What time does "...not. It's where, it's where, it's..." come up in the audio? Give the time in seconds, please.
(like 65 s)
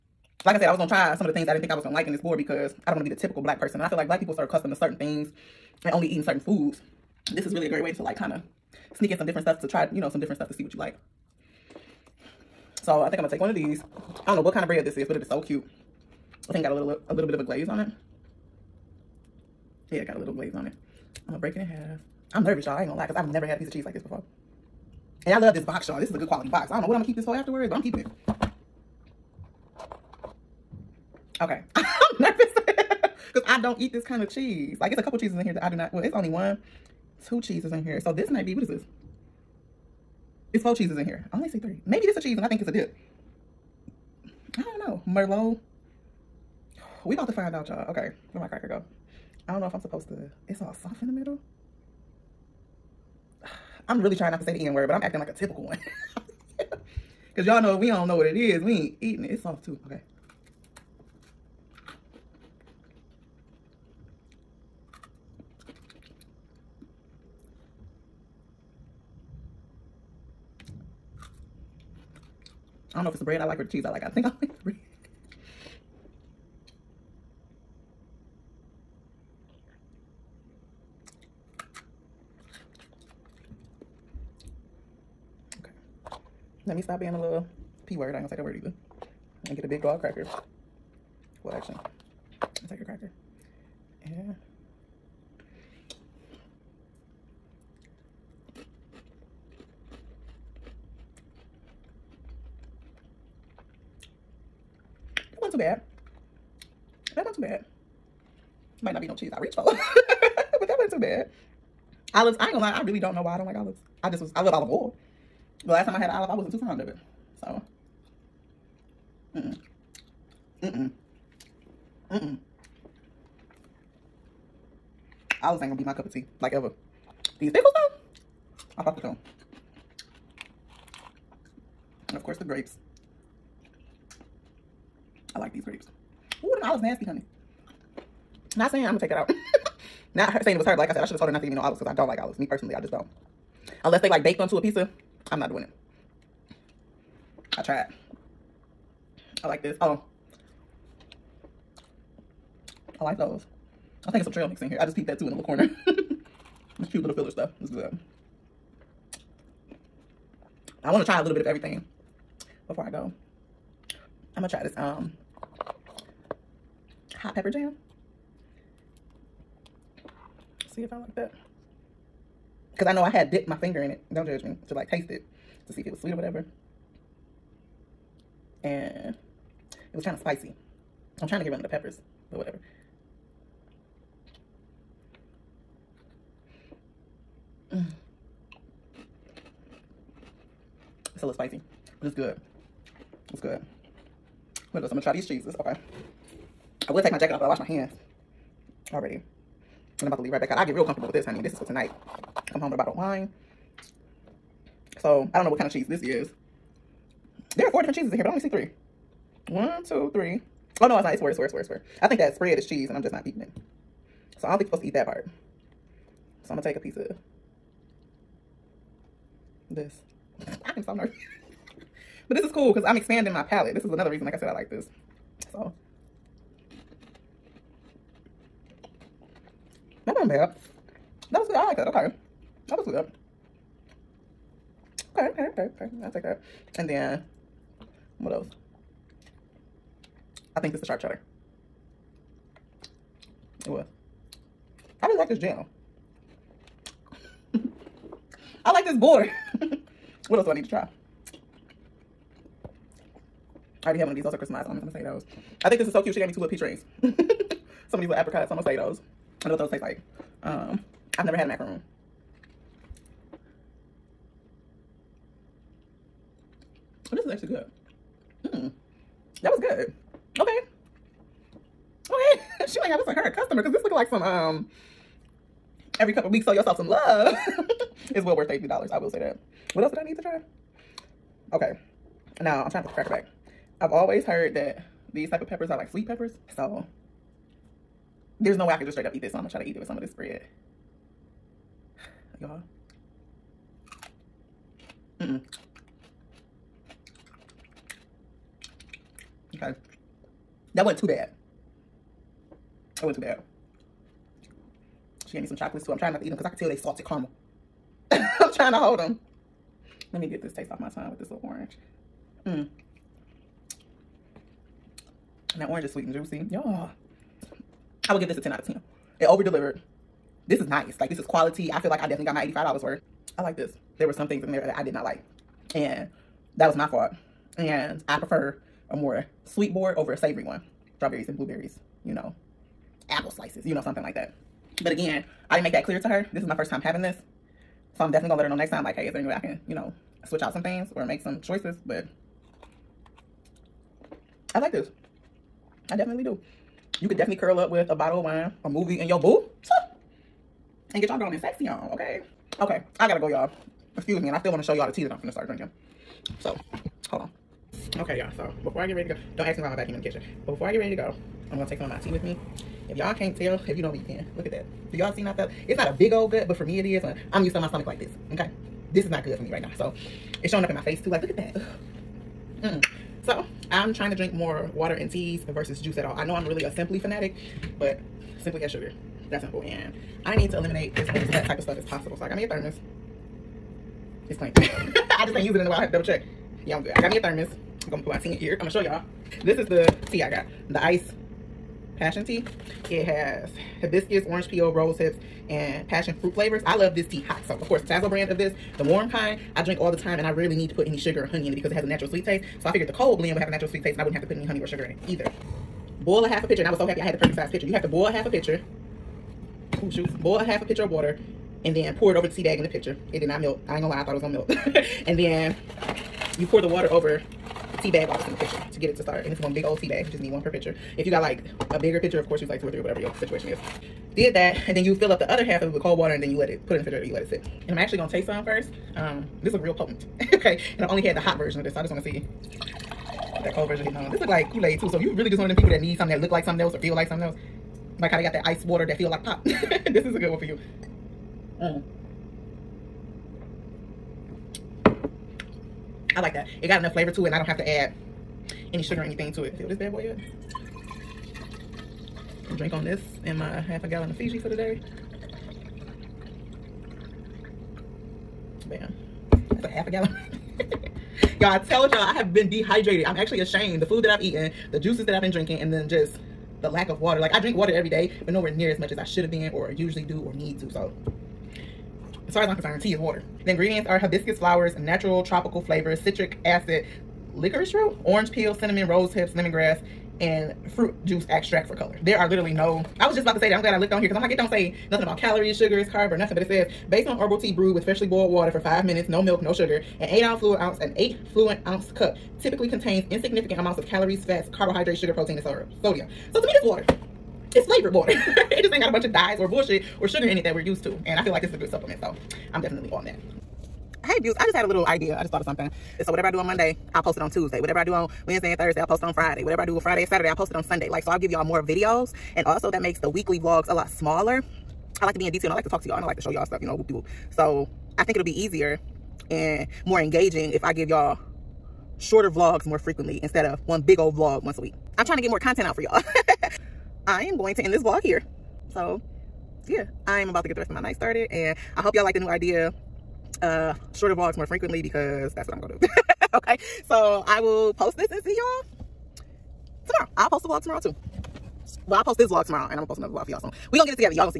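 211 s.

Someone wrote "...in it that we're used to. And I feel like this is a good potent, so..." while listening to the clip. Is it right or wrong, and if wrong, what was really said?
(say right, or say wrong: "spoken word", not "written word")
wrong: "supplement", not "potent".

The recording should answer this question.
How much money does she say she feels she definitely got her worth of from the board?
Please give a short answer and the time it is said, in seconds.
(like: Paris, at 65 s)
$85, at 322 s.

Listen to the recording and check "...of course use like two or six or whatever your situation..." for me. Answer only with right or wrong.
wrong.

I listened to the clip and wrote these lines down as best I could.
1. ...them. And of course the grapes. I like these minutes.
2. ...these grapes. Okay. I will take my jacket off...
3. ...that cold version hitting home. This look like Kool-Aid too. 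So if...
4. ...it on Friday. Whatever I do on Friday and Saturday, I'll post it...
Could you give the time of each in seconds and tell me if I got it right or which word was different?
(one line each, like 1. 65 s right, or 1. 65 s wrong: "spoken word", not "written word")
1. 129 s wrong: "grapes", not "minutes"
2. 195 s wrong: "cheeses", not "grapes"
3. 433 s right
4. 508 s right.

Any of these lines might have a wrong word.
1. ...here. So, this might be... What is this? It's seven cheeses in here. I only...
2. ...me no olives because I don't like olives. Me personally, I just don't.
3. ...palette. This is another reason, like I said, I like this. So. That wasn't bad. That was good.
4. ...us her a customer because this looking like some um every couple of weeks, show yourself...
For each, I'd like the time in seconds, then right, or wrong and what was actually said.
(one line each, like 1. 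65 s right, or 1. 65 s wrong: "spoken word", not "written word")
1. 37 s wrong: "four", not "seven"
2. 141 s right
3. 223 s right
4. 272 s right.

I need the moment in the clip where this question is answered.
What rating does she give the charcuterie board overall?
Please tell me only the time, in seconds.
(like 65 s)
318 s.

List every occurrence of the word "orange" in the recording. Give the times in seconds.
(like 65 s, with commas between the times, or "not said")
311 s, 315 s, 394 s, 478 s.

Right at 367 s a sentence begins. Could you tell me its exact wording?
I'm used to my stomach like this, okay?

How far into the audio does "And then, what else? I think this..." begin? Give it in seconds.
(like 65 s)
236 s.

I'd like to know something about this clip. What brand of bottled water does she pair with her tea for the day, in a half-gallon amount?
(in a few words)
Fiji.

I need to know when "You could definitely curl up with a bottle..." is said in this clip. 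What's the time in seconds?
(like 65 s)
346 s.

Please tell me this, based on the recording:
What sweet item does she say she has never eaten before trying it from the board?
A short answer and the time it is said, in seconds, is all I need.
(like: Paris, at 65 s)
macaroon, at 261 s.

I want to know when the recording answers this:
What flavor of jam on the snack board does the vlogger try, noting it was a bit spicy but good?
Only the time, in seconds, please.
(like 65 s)
167 s.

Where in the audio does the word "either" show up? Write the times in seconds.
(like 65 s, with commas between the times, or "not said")
88 s, 405 s.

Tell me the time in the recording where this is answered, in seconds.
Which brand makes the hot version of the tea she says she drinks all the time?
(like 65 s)
397 s.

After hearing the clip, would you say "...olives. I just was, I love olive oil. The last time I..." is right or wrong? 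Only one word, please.
right.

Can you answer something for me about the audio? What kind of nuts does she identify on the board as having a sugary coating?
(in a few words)
crystallized almonds.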